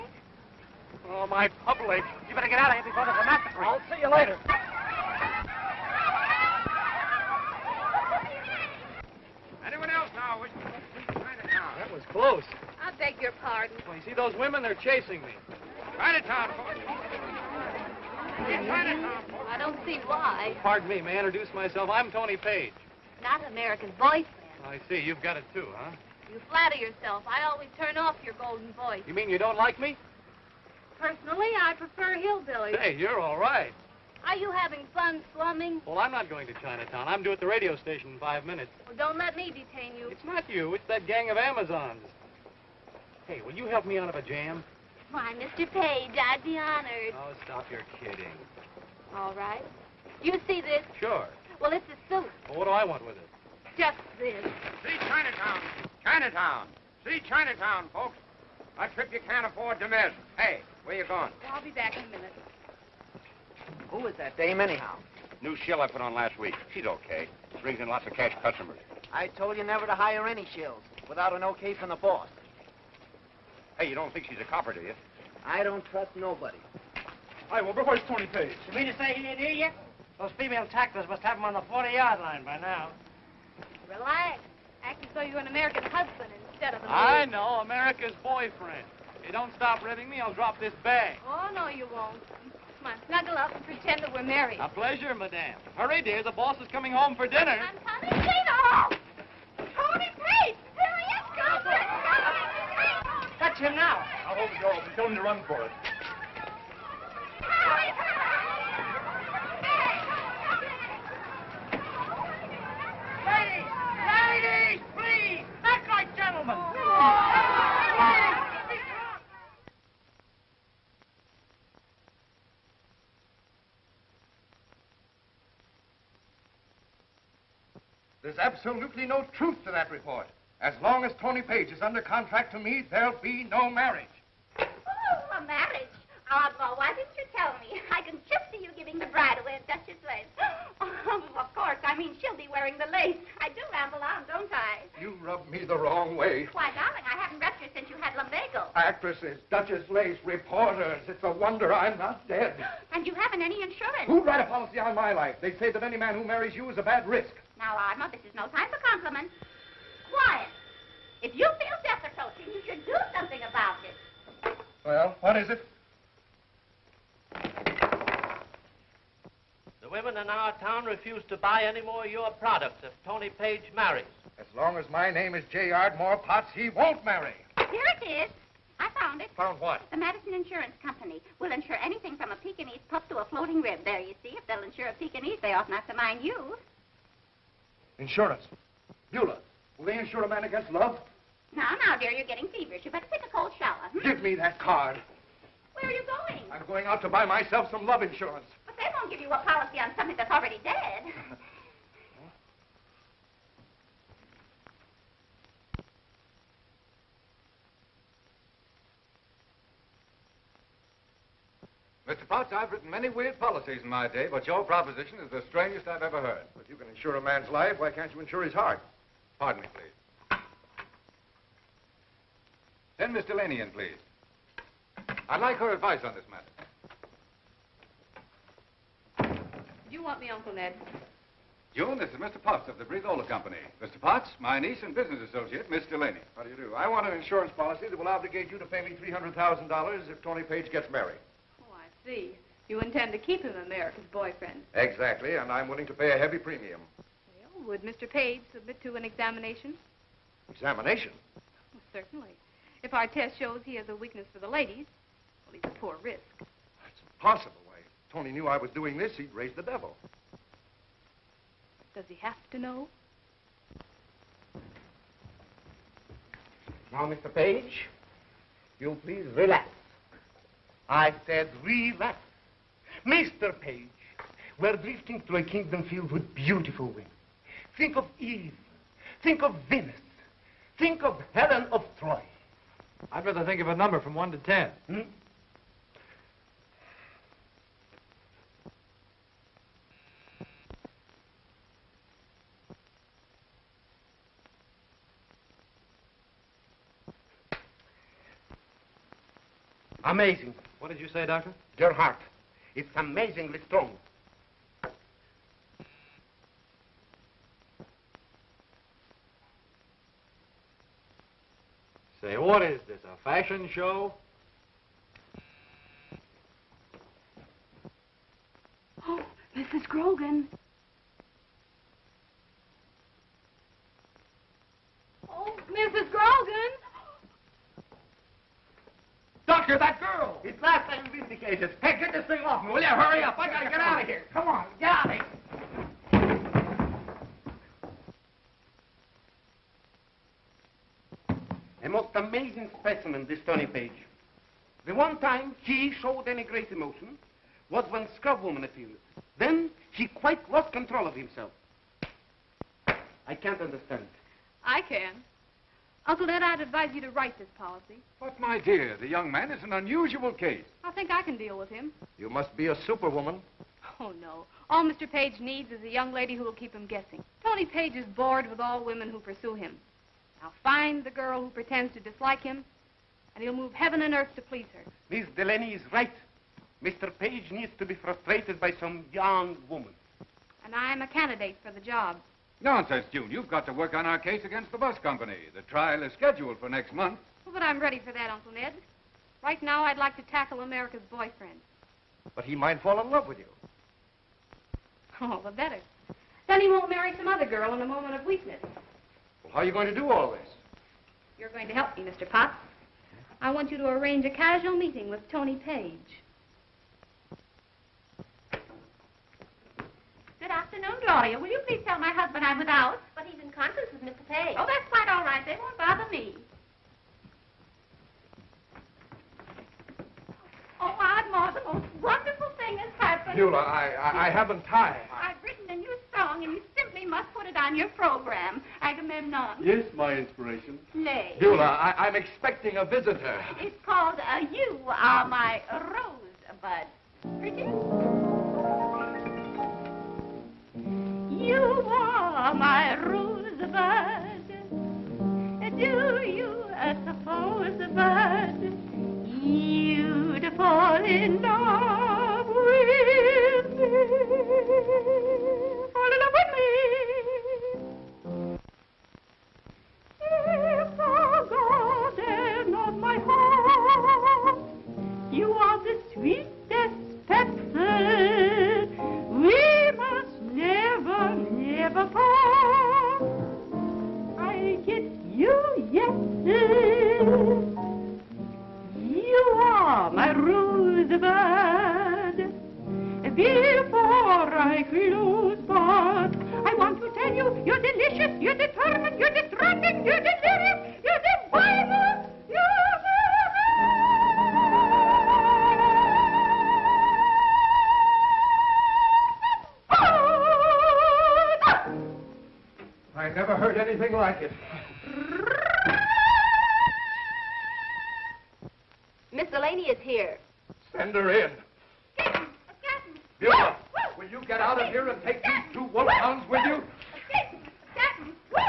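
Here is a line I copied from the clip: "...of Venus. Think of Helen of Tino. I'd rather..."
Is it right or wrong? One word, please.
wrong.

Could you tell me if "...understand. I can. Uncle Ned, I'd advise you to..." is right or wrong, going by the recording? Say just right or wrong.
right.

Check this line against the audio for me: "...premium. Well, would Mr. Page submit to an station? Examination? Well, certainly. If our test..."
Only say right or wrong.
wrong.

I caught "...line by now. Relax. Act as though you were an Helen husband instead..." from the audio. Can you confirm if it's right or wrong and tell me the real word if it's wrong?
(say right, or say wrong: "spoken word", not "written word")
wrong: "American", not "Helen".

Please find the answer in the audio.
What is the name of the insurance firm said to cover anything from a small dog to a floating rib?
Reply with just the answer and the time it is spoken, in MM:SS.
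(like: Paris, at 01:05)
Madison Insurance Company, at 02:59.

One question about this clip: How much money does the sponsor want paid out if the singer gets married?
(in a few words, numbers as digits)
$300,000.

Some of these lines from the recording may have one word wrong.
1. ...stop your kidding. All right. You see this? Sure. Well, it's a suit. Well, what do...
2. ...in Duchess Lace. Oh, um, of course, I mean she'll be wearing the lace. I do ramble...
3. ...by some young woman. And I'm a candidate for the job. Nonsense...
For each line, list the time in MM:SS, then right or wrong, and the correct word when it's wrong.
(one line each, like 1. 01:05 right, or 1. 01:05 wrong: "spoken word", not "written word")
1. 00:47 right
2. 02:19 right
3. 06:18 right.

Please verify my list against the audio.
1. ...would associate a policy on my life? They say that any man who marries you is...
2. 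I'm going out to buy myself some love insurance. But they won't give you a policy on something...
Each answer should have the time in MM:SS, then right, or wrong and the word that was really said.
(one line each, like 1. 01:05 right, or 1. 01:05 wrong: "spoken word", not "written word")
1. 02:34 wrong: "write", not "associate"
2. 03:16 right.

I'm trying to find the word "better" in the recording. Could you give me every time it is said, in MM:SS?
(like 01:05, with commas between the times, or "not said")
00:02, 03:12, 06:35.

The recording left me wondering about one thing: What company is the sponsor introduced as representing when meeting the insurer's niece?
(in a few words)
Breathola Company.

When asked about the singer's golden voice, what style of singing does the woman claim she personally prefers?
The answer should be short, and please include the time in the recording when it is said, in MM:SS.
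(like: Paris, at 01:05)
Hillbilly, at 00:32.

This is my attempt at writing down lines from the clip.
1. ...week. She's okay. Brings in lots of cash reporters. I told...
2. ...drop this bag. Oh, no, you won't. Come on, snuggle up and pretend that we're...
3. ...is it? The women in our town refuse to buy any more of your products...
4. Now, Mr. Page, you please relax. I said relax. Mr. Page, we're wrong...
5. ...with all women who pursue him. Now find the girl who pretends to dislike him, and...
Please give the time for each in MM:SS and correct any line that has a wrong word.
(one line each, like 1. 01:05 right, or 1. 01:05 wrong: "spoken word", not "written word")
1. 01:06 wrong: "customers", not "reporters"
2. 01:30 right
3. 02:45 right
4. 04:26 wrong: "drifting", not "wrong"
5. 06:08 right.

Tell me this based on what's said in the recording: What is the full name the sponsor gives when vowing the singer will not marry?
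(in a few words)
J. Ardmore Potts.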